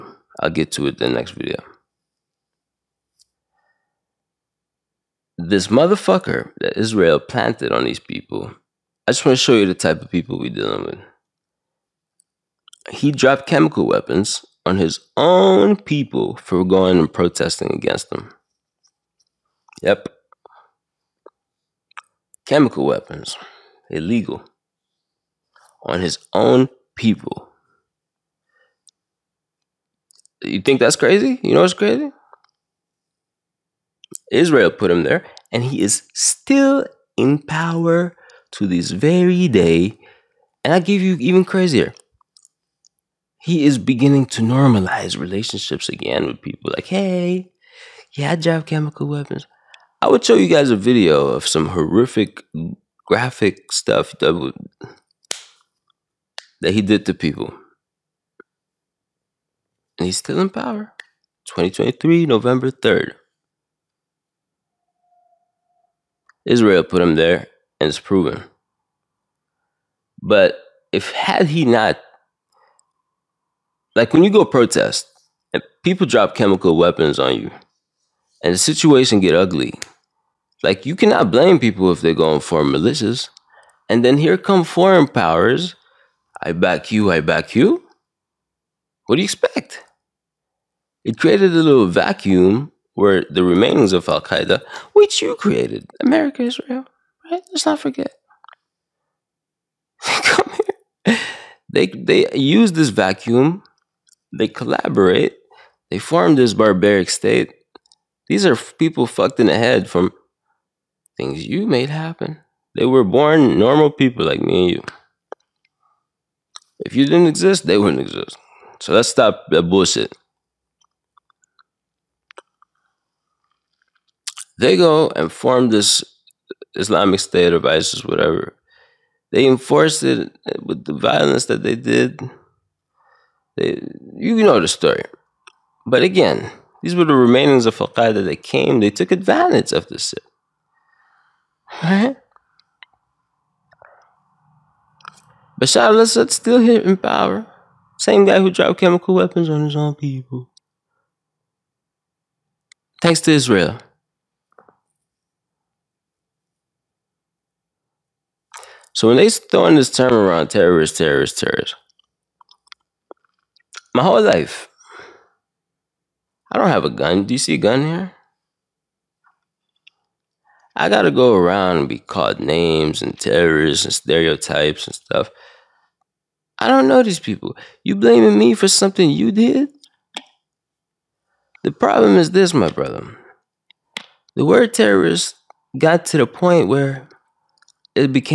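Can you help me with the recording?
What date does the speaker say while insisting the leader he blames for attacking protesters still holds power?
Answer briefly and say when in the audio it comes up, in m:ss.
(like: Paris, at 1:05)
November 3, 2023, at 1:01.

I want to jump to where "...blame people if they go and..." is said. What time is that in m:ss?
1:21.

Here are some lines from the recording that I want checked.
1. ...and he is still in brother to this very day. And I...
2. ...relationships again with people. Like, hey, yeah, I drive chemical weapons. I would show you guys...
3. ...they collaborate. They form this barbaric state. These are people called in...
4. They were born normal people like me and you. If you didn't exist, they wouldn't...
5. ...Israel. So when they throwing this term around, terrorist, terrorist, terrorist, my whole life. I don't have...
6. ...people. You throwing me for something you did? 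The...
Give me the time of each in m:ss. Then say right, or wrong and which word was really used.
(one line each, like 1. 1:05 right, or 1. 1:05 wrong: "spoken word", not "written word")
1. 0:35 wrong: "power", not "brother"
2. 0:45 right
3. 1:44 wrong: "fucked", not "called"
4. 1:52 right
5. 2:33 right
6. 2:57 wrong: "blaming", not "throwing".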